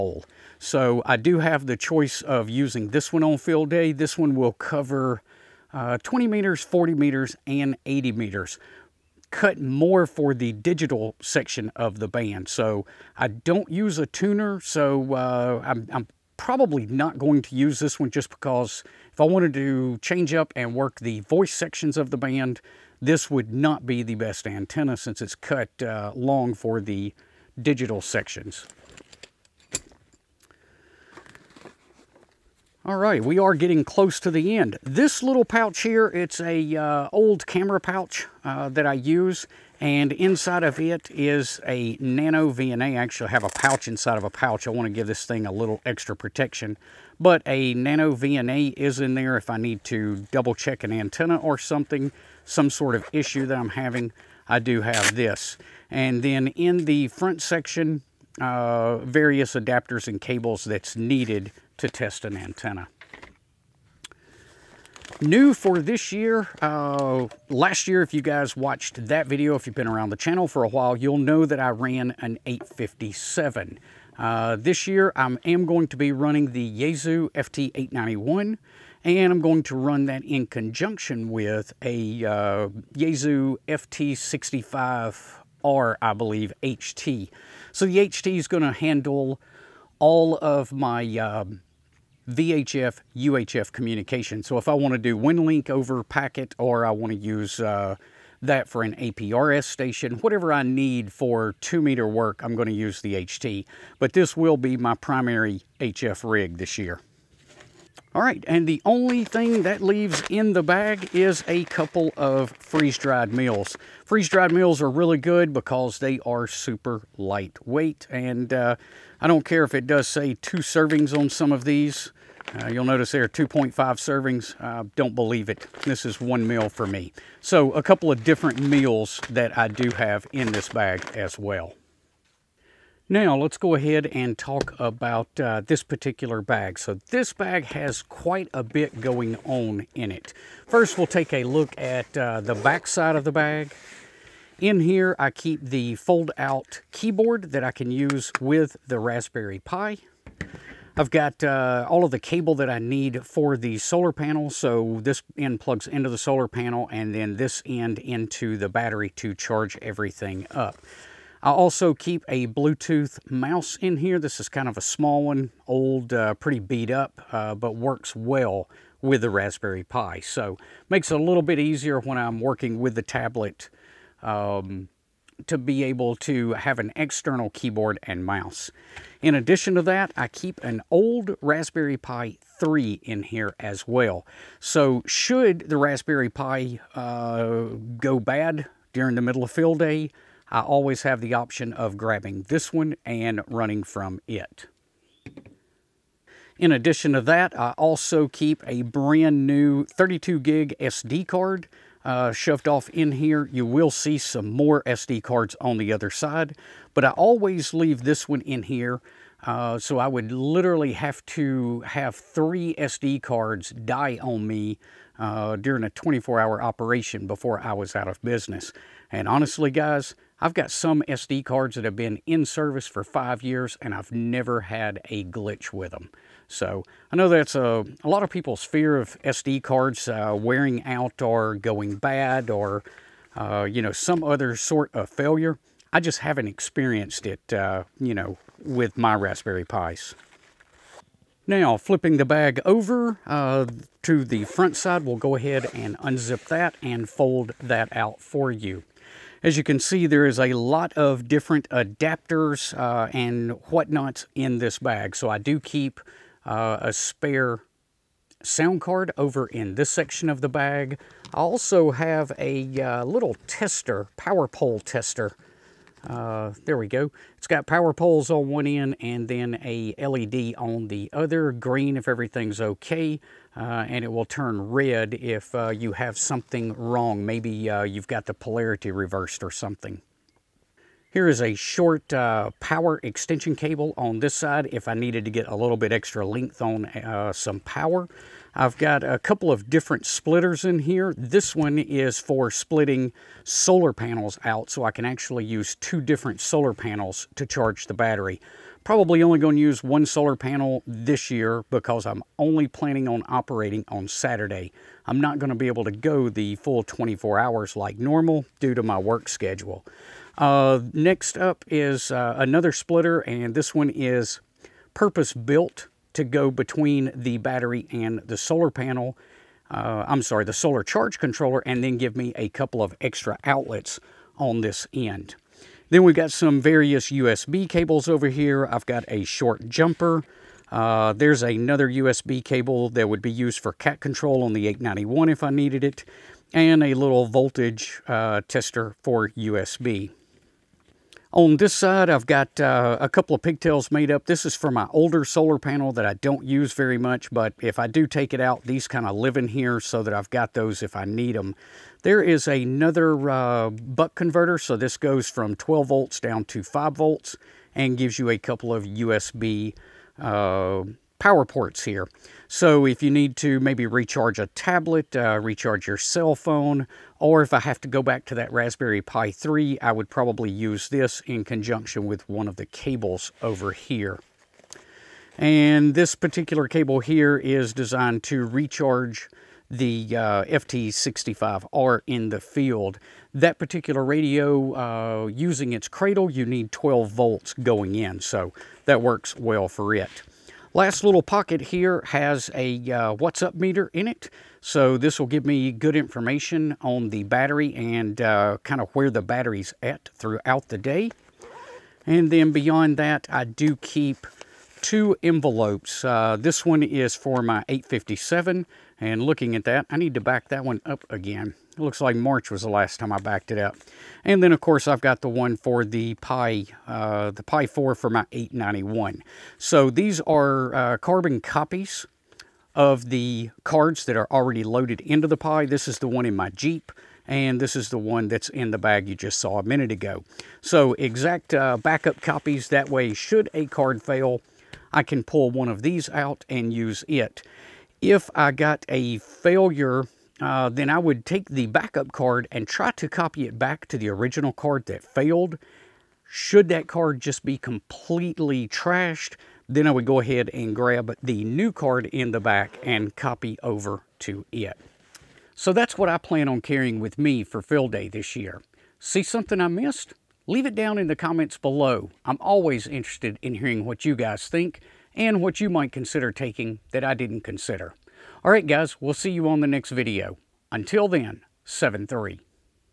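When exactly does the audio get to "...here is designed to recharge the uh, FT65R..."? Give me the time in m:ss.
6:16.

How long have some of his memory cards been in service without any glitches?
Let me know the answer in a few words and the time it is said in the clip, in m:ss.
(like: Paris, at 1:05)
five years, at 3:43.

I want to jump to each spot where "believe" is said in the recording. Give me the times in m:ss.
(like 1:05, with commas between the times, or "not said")
1:26, 2:05.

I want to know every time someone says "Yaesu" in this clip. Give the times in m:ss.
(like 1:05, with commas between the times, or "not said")
1:16, 1:22.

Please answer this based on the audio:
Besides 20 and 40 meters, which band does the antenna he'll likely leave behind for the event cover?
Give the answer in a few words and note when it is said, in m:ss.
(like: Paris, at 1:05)
80 meters, at 0:07.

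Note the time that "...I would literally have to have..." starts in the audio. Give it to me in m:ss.
3:29.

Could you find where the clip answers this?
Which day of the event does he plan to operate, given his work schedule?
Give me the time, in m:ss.
5:04.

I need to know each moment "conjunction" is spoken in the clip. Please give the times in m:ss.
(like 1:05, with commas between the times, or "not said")
1:20, 6:11.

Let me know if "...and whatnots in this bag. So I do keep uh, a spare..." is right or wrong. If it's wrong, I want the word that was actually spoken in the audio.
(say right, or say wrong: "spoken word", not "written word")
right.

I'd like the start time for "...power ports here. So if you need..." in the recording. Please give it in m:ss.
6:01.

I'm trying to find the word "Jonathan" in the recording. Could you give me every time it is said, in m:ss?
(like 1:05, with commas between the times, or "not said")
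not said.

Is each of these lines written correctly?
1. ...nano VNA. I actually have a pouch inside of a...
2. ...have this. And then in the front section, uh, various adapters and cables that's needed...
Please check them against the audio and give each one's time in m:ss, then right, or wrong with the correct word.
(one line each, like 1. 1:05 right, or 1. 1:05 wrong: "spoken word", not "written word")
1. 0:41 right
2. 0:54 right.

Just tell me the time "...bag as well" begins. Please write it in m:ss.
2:10.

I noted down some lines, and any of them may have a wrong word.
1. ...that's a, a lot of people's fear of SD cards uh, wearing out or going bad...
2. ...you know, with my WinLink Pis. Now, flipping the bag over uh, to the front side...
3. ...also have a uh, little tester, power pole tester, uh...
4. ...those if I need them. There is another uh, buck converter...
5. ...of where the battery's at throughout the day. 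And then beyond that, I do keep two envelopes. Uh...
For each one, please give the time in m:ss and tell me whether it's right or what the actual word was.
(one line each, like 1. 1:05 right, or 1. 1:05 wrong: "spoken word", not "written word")
1. 3:47 right
2. 3:57 wrong: "Raspberry", not "WinLink"
3. 4:21 right
4. 5:50 right
5. 6:38 right.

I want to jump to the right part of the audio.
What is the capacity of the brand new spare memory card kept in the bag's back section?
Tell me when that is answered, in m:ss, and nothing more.
3:19.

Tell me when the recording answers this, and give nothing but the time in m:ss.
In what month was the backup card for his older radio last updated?
6:52.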